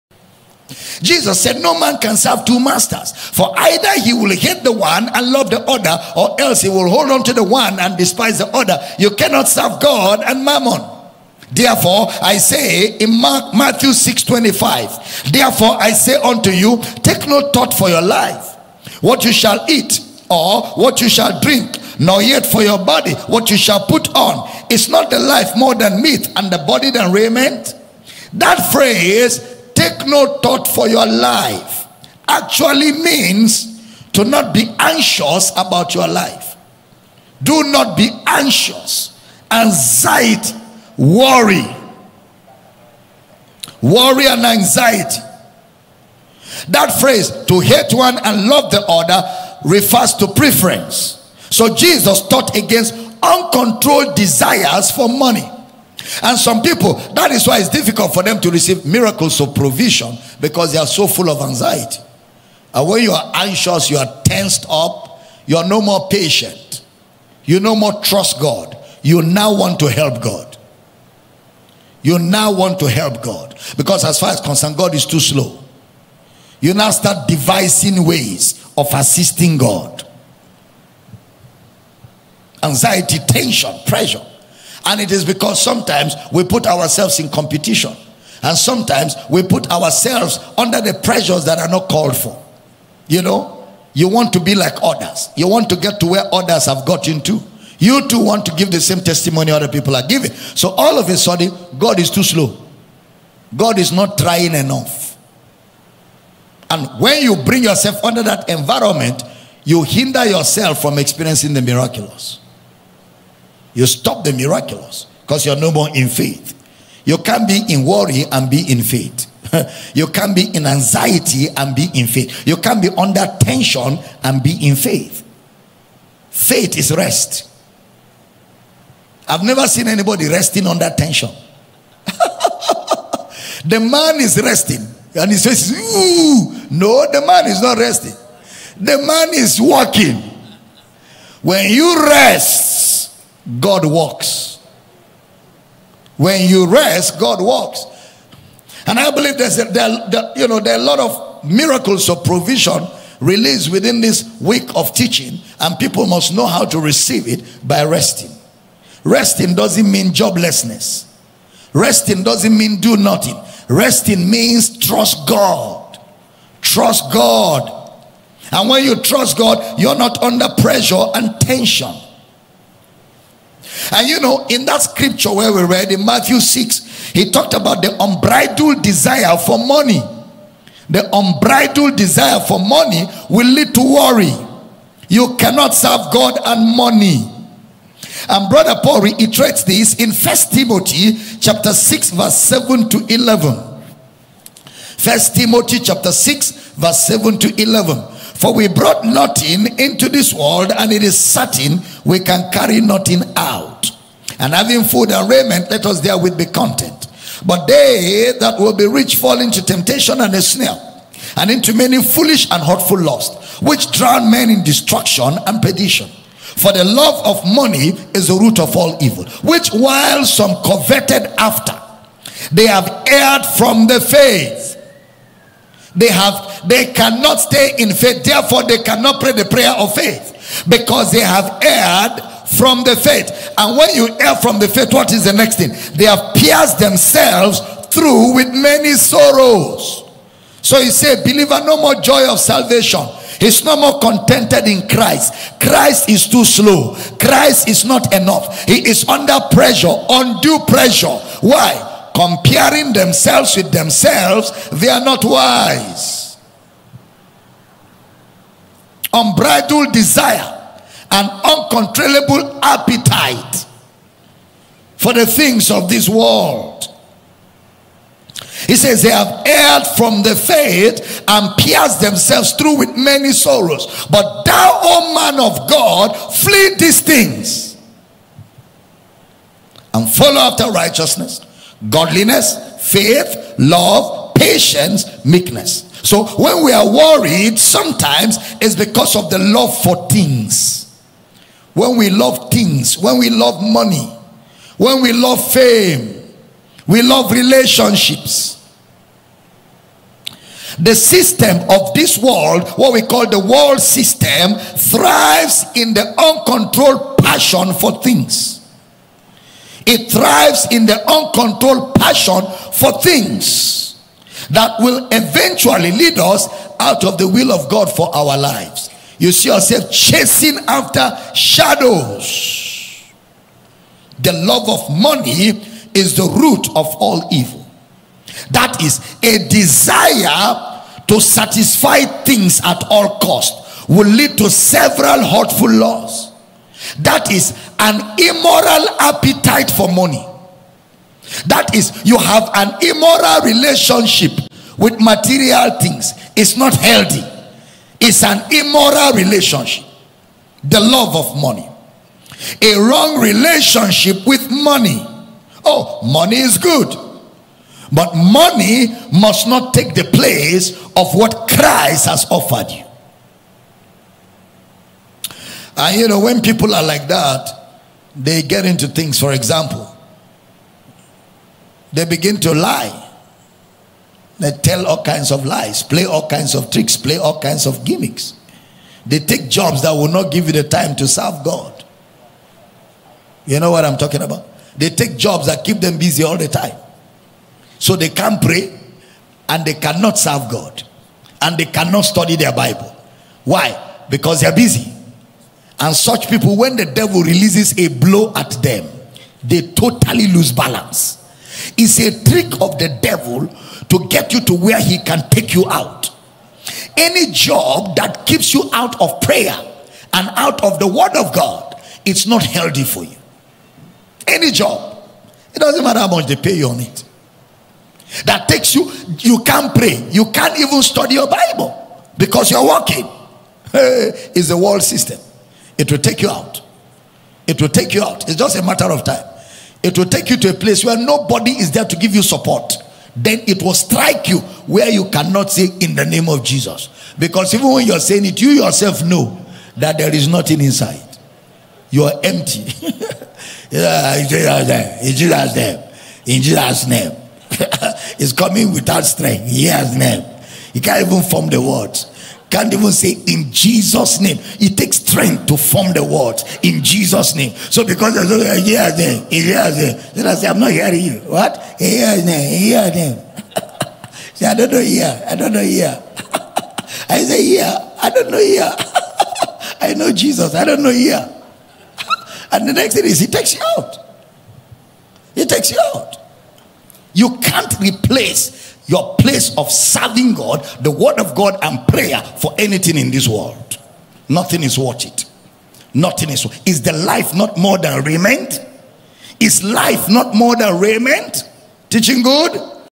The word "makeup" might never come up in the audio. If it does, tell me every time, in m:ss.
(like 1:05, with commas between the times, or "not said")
not said.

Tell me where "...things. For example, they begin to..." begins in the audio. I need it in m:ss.
6:08.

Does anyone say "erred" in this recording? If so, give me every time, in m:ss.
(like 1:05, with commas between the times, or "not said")
3:43, 3:51, 4:29.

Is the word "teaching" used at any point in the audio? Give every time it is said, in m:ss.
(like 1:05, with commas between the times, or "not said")
2:34, 8:11.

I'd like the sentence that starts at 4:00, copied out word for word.
So he said, Believer, no more joy of salvation.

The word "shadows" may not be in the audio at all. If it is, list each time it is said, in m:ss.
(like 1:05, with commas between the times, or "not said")
5:21.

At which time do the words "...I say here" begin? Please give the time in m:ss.
7:47.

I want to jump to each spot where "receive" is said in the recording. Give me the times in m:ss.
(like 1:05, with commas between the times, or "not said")
0:58, 2:36.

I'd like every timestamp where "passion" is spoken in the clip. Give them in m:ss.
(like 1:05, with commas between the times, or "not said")
5:07, 5:11.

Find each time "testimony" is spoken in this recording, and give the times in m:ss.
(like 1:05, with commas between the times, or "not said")
1:38.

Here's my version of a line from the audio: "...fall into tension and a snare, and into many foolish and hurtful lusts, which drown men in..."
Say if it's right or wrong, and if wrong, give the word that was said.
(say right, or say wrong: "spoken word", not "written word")
wrong: "temptation", not "tension".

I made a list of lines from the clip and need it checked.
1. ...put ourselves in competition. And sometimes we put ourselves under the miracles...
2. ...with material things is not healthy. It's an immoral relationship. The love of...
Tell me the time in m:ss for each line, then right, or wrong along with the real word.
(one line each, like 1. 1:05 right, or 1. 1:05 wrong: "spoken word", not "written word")
1. 1:26 wrong: "pressures", not "miracles"
2. 5:44 right.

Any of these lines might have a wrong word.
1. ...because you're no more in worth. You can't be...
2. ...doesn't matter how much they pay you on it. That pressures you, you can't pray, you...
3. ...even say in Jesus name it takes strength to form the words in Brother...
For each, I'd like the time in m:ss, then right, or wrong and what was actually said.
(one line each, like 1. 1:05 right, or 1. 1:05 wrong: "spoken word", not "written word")
1. 1:55 wrong: "faith", not "worth"
2. 6:55 wrong: "takes", not "pressures"
3. 7:32 wrong: "Jesus", not "Brother".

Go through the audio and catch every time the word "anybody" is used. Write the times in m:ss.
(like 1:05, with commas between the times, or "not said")
2:09.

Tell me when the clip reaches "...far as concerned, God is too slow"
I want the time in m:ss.
1:14.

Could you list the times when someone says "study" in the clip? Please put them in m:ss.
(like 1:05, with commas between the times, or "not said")
6:32, 7:00.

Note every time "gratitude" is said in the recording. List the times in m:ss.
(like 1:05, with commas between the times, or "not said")
not said.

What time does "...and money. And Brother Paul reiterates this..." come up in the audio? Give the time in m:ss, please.
3:06.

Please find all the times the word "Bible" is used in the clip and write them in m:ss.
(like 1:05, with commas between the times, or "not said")
6:32, 7:01.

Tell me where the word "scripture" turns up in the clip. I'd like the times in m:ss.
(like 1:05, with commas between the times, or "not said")
2:54.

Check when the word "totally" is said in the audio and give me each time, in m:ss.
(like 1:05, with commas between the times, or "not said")
6:39.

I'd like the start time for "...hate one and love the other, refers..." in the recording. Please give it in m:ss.
0:47.